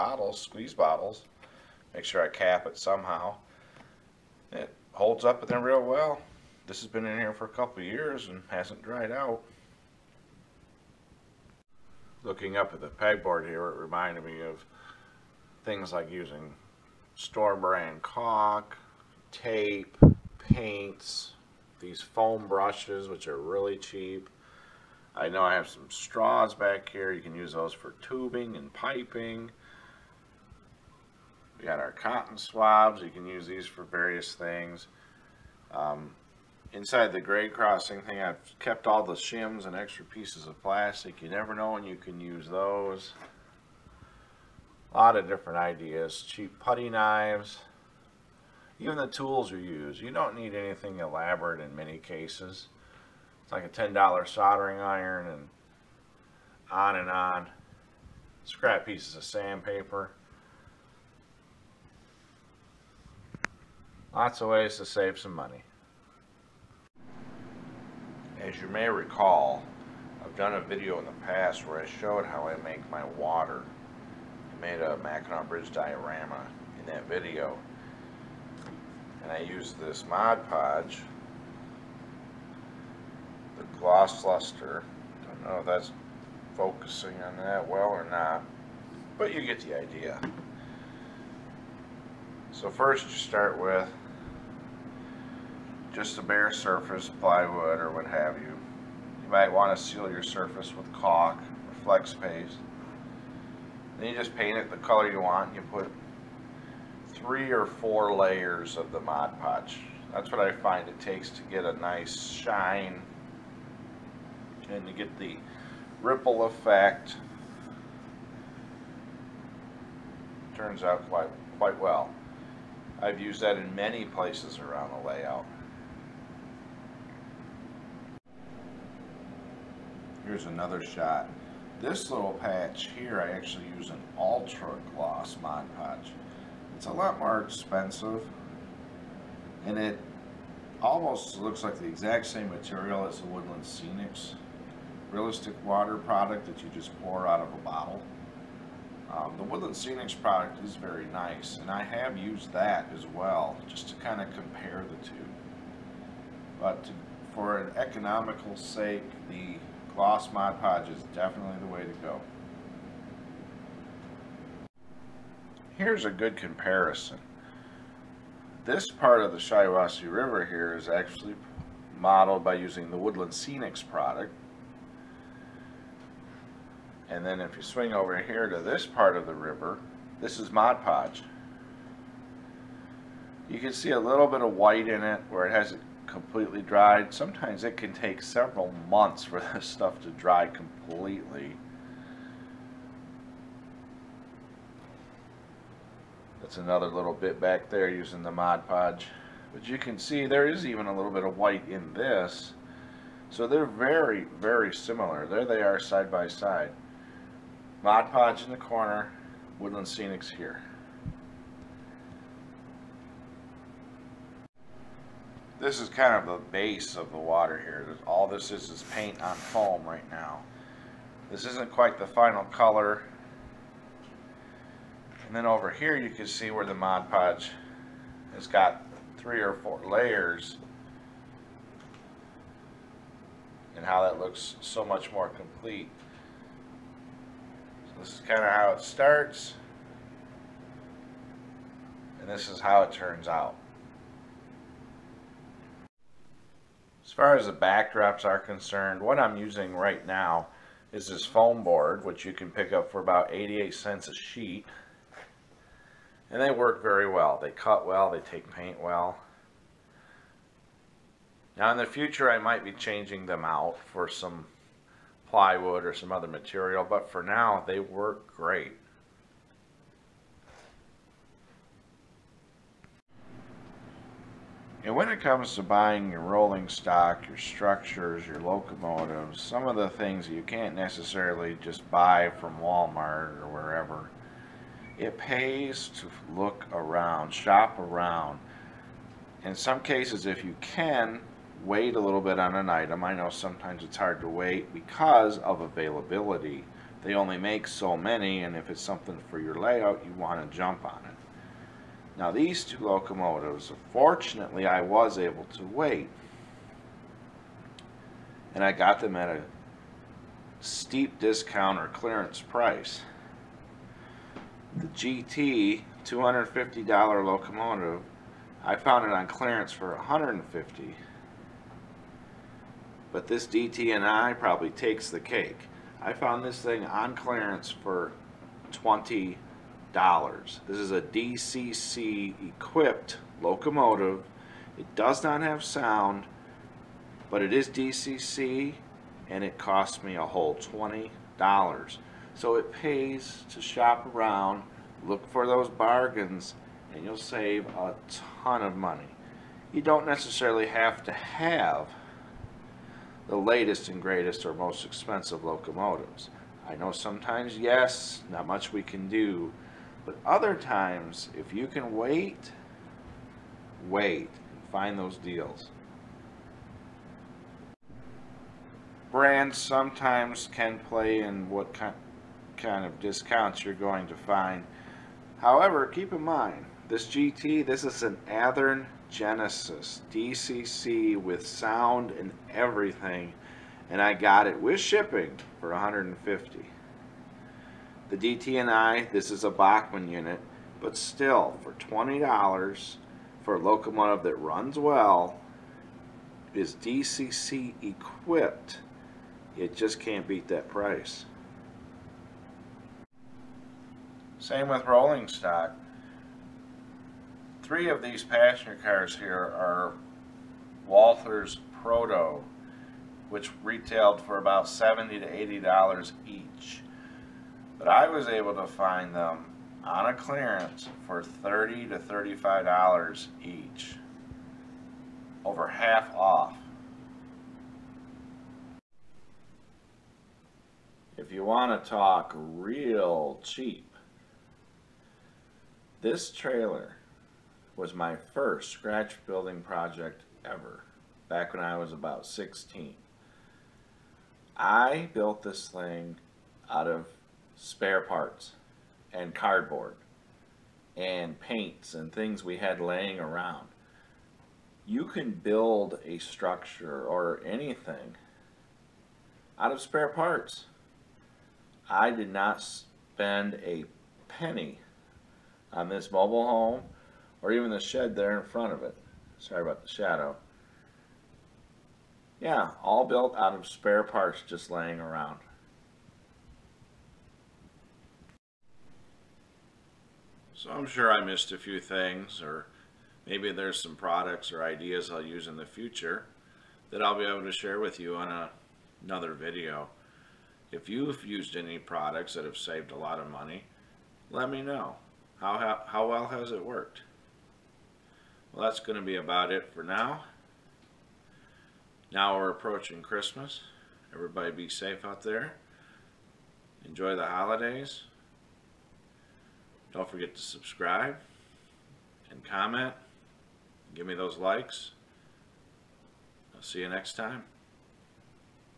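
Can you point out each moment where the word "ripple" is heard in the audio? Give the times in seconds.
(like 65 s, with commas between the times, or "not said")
116 s.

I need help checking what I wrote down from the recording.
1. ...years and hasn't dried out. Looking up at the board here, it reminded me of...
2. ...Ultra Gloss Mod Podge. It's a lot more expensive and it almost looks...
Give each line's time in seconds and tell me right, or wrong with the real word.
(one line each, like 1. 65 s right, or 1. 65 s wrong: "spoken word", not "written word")
1. 7 s wrong: "pegboard", not "board"
2. 134 s right.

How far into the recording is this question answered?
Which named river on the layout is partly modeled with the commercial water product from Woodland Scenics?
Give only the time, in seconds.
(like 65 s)
169 s.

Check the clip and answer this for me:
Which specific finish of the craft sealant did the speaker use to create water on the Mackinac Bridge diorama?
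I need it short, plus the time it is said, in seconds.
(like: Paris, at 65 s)
Gloss Luster, at 83 s.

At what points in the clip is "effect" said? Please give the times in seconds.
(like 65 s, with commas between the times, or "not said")
116 s.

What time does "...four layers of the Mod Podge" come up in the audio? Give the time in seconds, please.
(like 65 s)
107 s.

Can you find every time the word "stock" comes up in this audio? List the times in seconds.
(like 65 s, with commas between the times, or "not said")
276 s, 405 s.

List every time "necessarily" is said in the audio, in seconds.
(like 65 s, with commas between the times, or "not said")
280 s, 350 s.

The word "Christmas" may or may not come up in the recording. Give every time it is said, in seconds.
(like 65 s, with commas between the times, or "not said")
503 s.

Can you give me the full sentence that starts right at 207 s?
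Mod Podge in the corner, Woodland Scenics here.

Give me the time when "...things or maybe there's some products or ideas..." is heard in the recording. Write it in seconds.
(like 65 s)
481 s.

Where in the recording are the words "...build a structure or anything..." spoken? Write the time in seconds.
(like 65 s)
455 s.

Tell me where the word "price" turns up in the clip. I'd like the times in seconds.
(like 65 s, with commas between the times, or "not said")
312 s, 400 s.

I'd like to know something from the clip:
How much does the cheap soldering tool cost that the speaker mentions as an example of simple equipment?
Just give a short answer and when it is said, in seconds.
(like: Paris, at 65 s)
$10, at 53 s.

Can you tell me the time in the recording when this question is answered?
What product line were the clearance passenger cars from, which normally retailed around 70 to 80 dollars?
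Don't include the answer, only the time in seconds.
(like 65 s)
410 s.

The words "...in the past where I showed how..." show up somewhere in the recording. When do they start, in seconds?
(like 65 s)
70 s.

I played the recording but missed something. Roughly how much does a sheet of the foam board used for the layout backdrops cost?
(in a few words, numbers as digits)
88 cents.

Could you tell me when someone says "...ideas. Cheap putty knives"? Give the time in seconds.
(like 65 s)
45 s.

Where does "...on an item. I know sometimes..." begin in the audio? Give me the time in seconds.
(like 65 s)
292 s.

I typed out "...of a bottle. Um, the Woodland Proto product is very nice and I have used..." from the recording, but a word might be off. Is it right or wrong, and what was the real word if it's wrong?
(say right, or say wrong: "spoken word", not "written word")
wrong: "Scenics", not "Proto".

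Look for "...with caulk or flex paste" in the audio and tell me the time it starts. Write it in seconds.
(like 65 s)
100 s.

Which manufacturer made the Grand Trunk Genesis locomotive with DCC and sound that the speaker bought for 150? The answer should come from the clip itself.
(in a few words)
Athearn.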